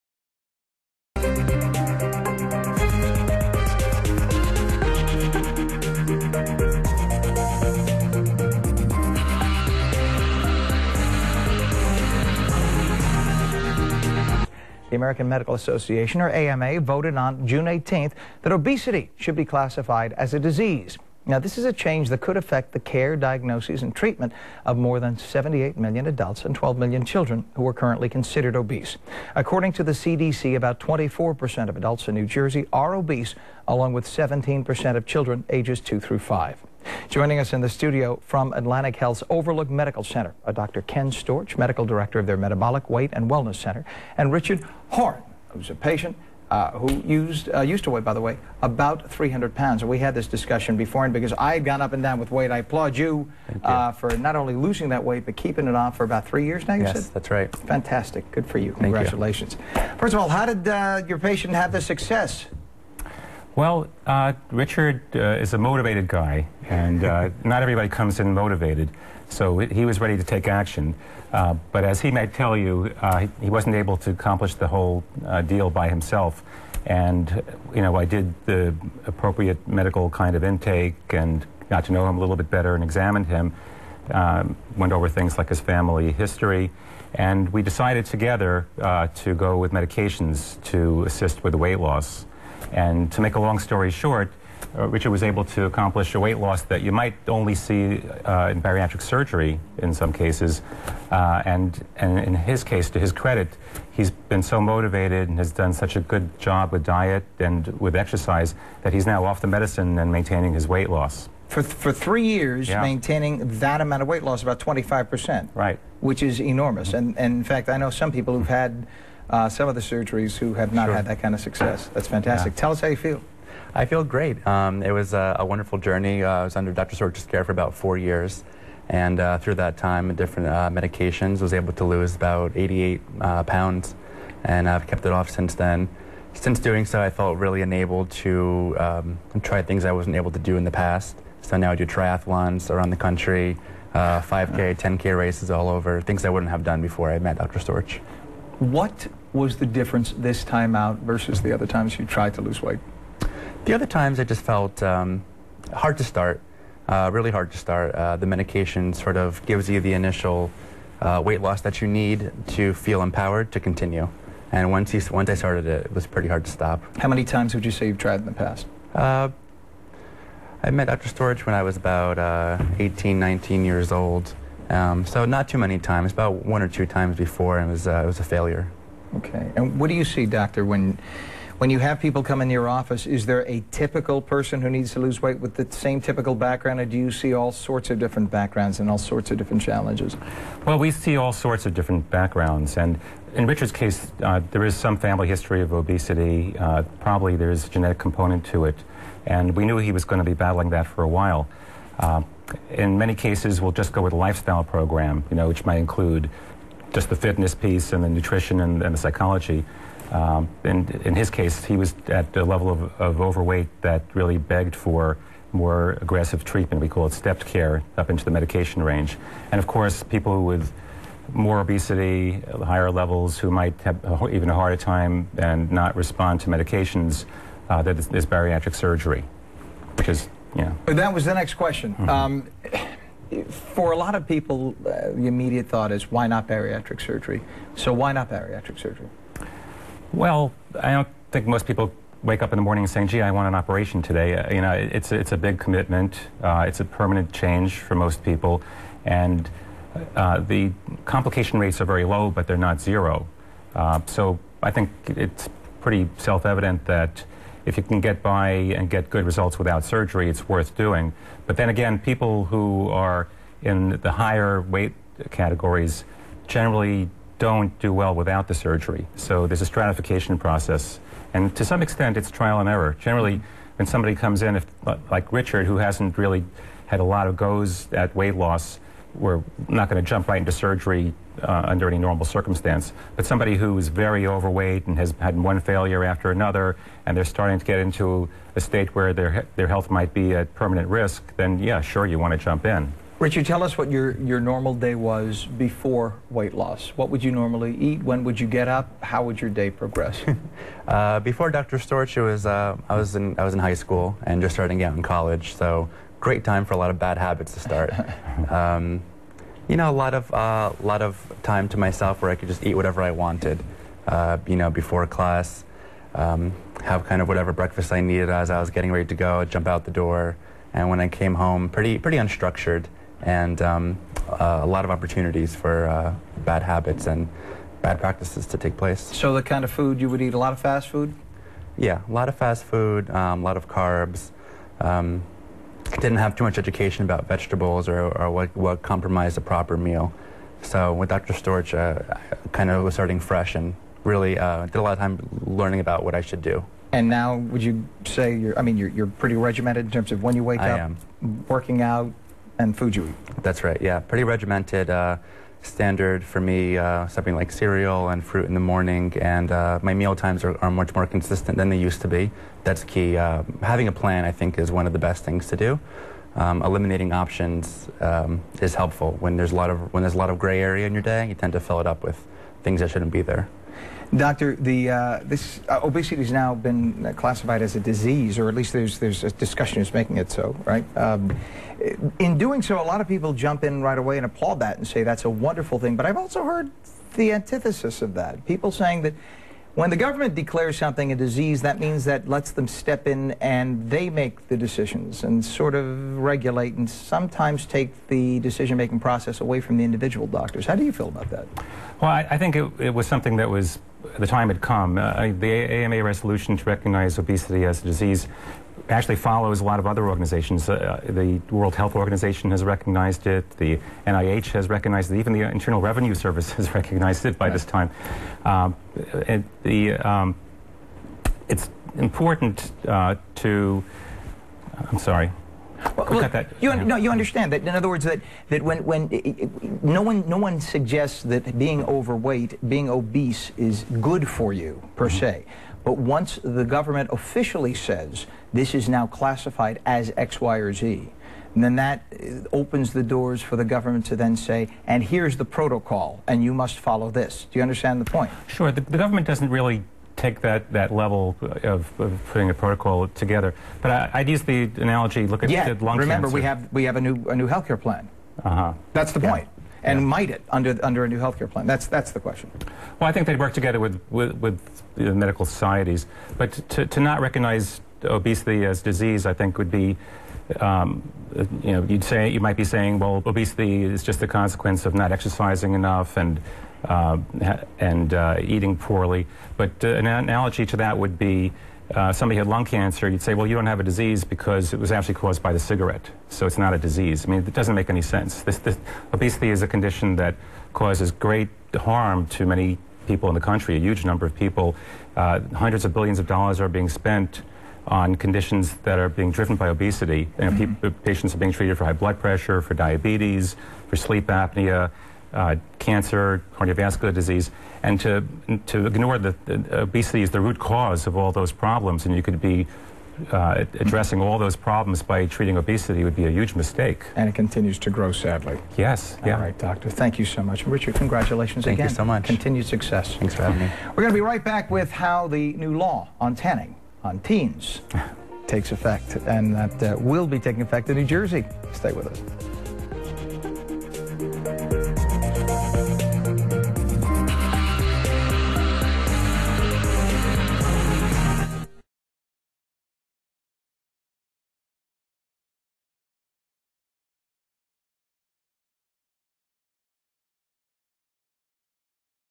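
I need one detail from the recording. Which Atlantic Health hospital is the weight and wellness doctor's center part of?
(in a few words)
Overlook Medical Center.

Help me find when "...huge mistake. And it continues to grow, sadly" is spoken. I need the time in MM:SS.
08:36.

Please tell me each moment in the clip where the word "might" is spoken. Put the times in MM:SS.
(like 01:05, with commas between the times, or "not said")
01:12, 01:36, 03:25, 03:43, 04:49, 07:40, 07:52.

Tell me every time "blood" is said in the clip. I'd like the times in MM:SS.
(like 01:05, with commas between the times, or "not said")
08:21.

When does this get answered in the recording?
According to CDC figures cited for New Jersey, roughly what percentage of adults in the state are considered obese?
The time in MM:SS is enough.
00:30.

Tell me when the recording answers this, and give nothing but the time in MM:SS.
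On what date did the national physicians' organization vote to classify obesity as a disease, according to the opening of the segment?
00:17.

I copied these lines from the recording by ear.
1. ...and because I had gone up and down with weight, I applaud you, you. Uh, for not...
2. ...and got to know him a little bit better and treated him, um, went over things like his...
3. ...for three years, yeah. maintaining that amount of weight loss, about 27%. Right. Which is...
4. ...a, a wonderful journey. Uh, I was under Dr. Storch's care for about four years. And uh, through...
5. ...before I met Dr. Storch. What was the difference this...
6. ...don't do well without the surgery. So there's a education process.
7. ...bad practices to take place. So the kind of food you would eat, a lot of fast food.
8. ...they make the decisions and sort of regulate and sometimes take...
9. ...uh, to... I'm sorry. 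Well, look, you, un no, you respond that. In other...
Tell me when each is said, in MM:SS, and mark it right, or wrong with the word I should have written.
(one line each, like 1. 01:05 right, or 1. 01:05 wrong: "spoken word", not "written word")
1. 00:51 right
2. 01:21 wrong: "examined", not "treated"
3. 01:51 wrong: "25", not "27"
4. 02:05 right
5. 02:26 right
6. 04:27 wrong: "stratification", not "education"
7. 05:27 right
8. 06:33 right
9. 07:02 wrong: "understand", not "respond".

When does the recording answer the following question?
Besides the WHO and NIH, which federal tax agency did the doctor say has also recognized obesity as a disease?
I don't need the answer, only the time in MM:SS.
06:55.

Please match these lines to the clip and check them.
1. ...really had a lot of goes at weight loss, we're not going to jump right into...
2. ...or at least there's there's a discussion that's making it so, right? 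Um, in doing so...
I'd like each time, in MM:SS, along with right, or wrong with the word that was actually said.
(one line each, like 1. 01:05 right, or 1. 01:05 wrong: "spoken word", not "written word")
1. 04:36 right
2. 06:18 right.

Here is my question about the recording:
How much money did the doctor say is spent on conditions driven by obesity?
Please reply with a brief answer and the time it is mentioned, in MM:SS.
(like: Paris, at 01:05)
Hundreds of billions of dollars, at 08:15.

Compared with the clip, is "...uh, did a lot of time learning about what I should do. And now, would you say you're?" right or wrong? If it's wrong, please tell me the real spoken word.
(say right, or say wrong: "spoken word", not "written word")
right.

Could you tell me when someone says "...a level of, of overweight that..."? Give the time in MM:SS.
03:32.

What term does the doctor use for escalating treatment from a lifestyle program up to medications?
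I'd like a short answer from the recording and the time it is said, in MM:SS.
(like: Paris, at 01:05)
Stepped care, at 03:37.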